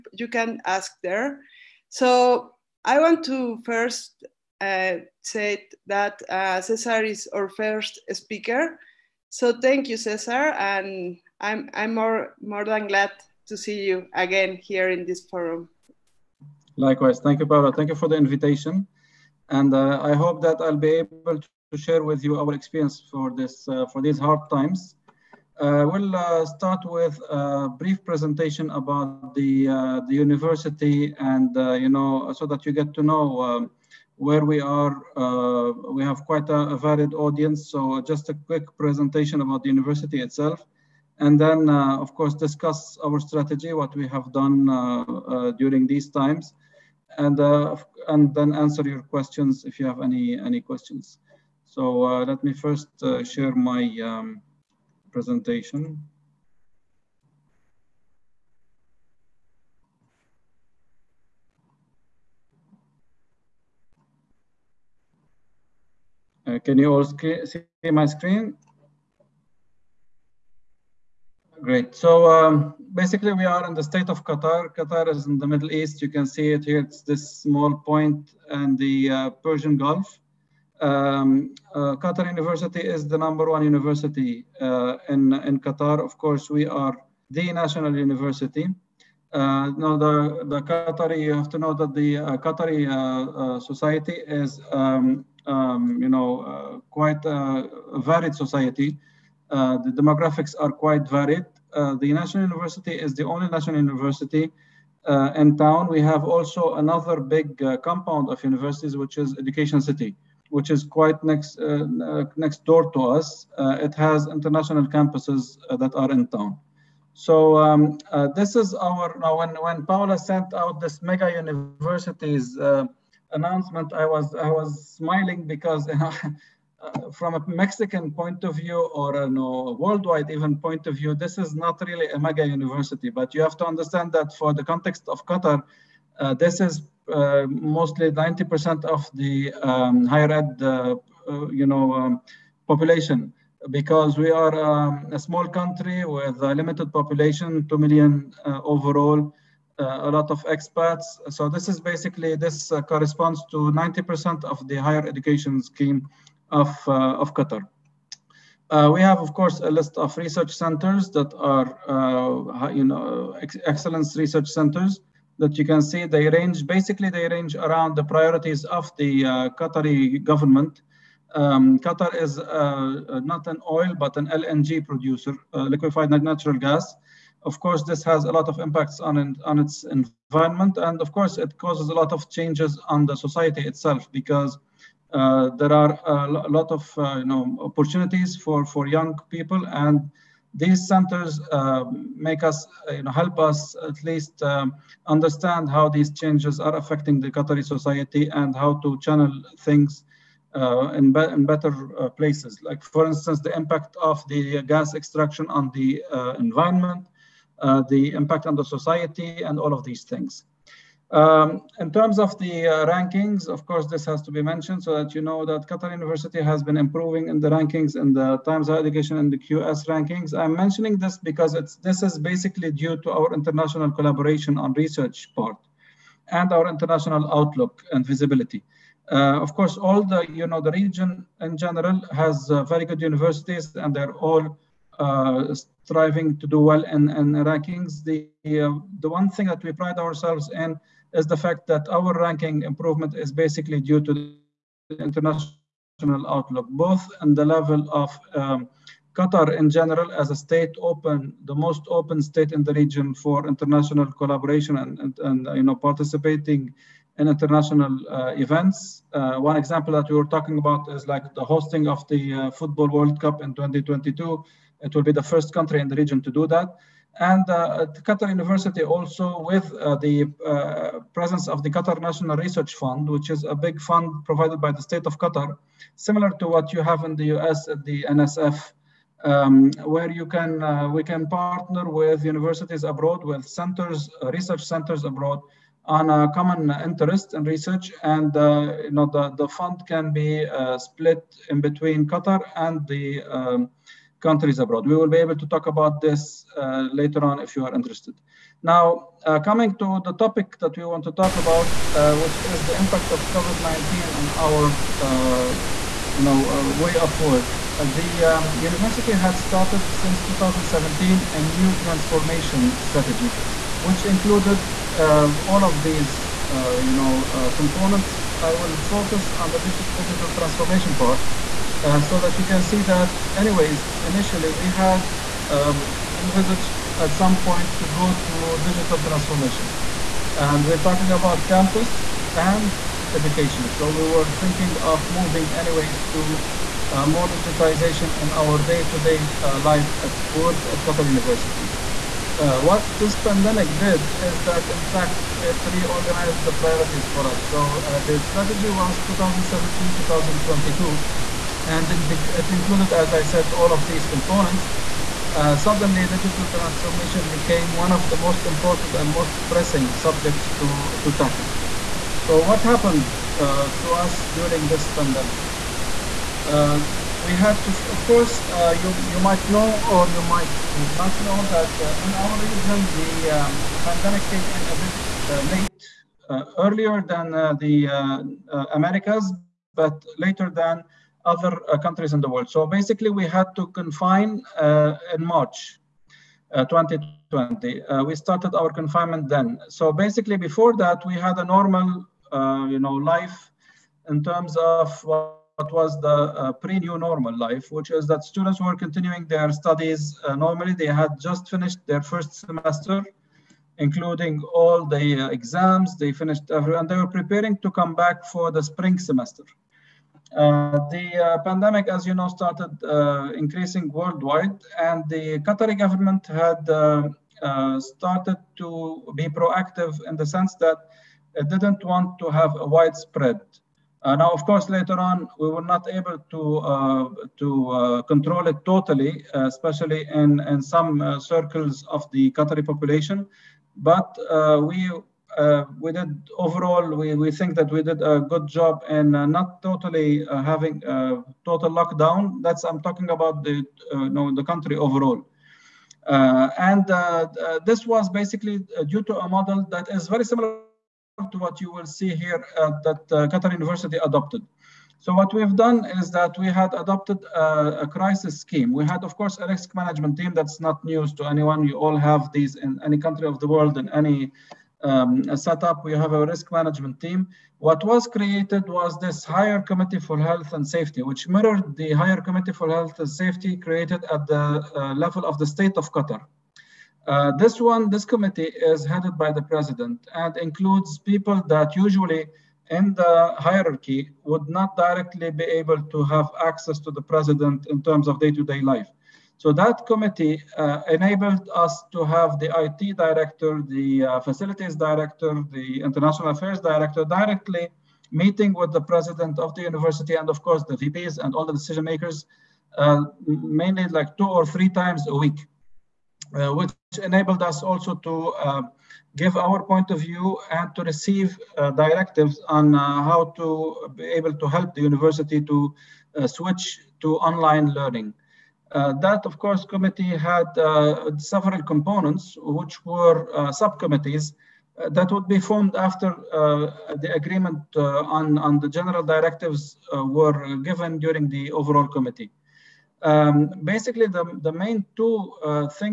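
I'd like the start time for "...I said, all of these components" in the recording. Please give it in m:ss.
5:53.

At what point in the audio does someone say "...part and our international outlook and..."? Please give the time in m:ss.
3:45.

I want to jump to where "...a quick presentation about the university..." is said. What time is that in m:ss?
0:38.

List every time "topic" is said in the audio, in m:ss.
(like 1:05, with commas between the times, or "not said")
5:00.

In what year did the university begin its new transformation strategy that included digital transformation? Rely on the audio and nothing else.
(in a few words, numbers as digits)
2017.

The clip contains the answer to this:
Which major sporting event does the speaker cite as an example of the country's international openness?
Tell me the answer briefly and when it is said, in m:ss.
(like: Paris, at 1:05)
Football World Cup, at 4:22.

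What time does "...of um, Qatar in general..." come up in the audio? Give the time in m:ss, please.
4:07.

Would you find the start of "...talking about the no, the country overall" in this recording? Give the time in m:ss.
7:22.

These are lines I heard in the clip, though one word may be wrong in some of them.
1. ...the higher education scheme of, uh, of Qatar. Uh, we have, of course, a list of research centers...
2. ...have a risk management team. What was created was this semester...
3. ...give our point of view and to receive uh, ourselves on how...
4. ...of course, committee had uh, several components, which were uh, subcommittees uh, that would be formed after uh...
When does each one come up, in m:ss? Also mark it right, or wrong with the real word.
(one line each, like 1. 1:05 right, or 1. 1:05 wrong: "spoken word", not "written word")
1. 2:34 right
2. 7:45 wrong: "higher", not "semester"
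3. 8:29 wrong: "directives", not "ourselves"
4. 8:39 right.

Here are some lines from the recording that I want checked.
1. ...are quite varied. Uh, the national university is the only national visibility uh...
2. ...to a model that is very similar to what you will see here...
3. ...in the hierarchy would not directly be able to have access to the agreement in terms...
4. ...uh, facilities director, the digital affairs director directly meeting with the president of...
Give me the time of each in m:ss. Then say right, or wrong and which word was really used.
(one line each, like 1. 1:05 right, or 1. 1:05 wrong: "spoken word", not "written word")
1. 1:40 wrong: "university", not "visibility"
2. 7:29 right
3. 8:02 wrong: "president", not "agreement"
4. 8:14 wrong: "international", not "digital".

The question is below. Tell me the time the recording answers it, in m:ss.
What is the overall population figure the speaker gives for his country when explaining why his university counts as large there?
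2:27.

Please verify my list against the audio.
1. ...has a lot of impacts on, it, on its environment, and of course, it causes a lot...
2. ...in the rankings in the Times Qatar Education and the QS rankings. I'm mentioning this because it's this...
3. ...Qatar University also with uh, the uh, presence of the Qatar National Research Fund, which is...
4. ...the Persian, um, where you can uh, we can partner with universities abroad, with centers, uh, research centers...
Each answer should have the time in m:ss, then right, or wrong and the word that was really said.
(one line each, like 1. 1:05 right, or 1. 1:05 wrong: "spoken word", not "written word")
1. 2:58 right
2. 3:37 wrong: "Higher", not "Qatar"
3. 4:28 right
4. 4:37 wrong: "NSF", not "Persian".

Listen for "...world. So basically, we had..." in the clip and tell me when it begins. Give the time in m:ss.
6:22.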